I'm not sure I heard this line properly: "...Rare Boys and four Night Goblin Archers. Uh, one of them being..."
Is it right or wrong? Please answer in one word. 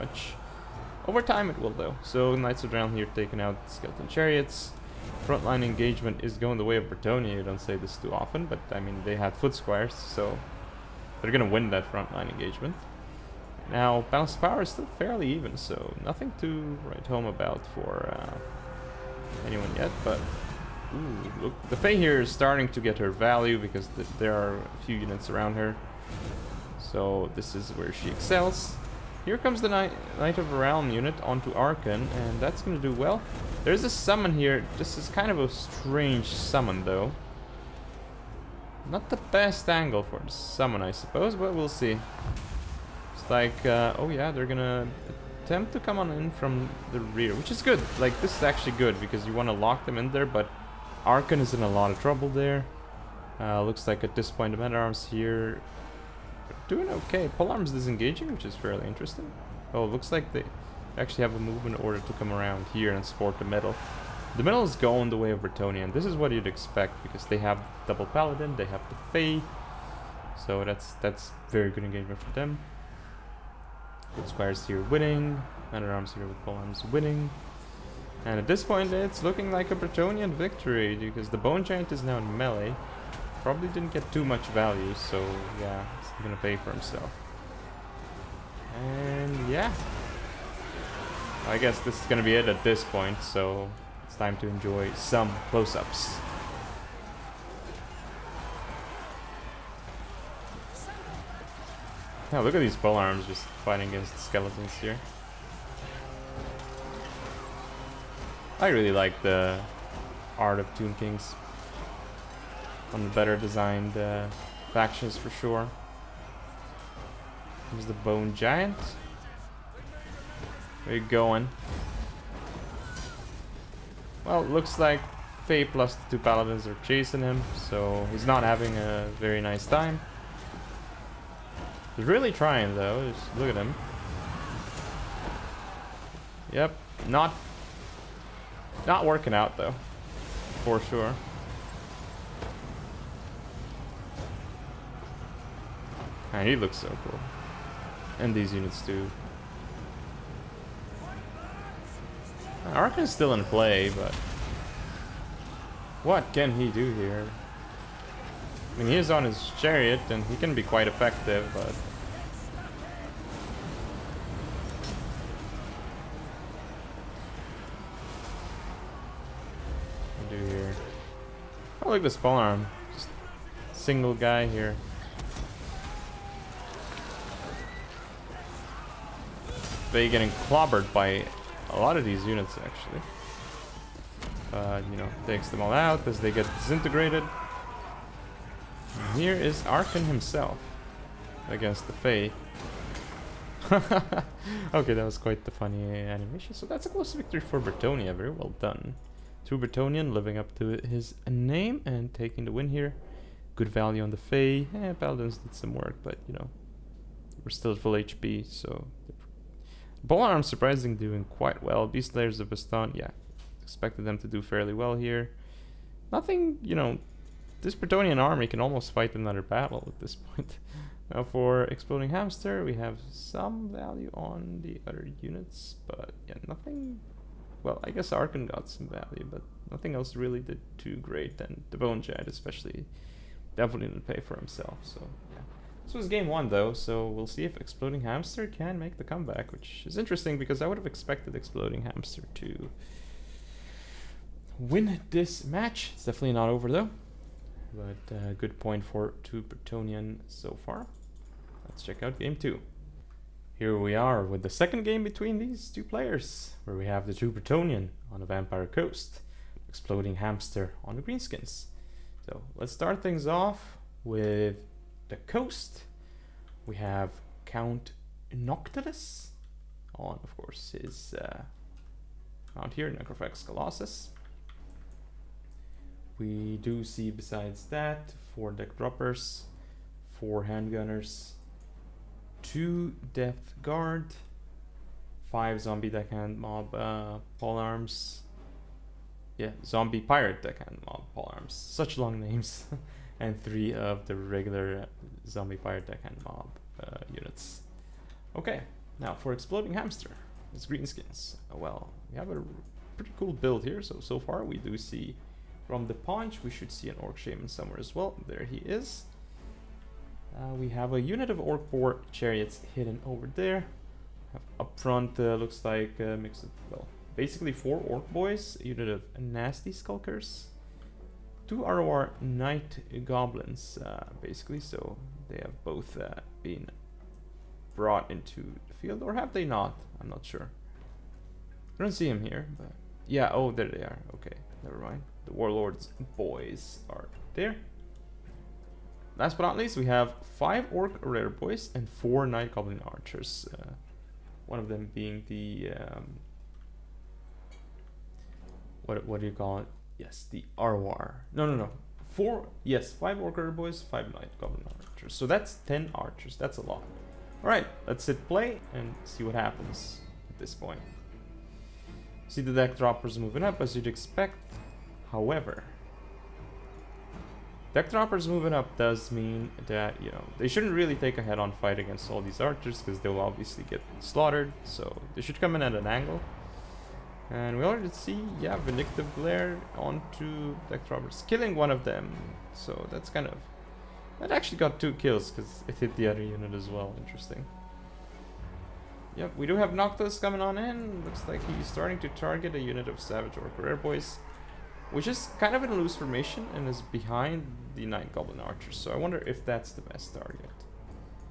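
right.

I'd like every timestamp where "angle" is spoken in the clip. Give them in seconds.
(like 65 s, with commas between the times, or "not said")
39 s, 375 s.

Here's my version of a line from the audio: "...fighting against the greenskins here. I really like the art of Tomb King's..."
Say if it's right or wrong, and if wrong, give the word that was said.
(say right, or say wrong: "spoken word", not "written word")
wrong: "skeletons", not "greenskins".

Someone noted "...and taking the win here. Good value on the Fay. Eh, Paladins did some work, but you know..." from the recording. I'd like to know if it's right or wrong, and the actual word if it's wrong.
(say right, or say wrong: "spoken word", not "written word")
right.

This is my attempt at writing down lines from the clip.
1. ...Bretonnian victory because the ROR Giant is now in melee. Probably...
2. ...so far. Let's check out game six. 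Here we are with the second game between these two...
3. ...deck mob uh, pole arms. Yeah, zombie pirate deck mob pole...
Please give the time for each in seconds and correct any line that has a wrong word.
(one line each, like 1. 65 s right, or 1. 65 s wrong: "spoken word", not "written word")
1. 79 s wrong: "Bone", not "ROR"
2. 250 s wrong: "two", not "six"
3. 285 s right.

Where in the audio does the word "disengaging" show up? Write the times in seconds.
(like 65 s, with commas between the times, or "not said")
57 s.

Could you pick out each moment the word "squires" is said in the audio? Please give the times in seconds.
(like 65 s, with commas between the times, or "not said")
9 s, 74 s.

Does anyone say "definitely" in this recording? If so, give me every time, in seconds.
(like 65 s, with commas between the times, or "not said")
233 s, 246 s.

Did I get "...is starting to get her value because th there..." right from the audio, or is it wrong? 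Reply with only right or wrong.
right.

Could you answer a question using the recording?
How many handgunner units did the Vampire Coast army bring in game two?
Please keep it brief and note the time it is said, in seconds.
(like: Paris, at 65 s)
4, at 280 s.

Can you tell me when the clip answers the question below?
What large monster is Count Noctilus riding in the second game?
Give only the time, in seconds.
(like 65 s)
272 s.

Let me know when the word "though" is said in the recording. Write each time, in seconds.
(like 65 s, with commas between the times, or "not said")
1 s, 36 s, 132 s, 139 s, 236 s, 246 s.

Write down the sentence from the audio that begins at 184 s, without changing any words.
Uh, you know, takes them all out as they get disintegrated.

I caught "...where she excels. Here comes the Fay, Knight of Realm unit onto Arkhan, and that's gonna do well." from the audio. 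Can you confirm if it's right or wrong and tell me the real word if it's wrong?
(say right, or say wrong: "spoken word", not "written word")
wrong: "Knight", not "Fay".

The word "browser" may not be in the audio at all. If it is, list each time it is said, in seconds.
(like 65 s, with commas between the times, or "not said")
not said.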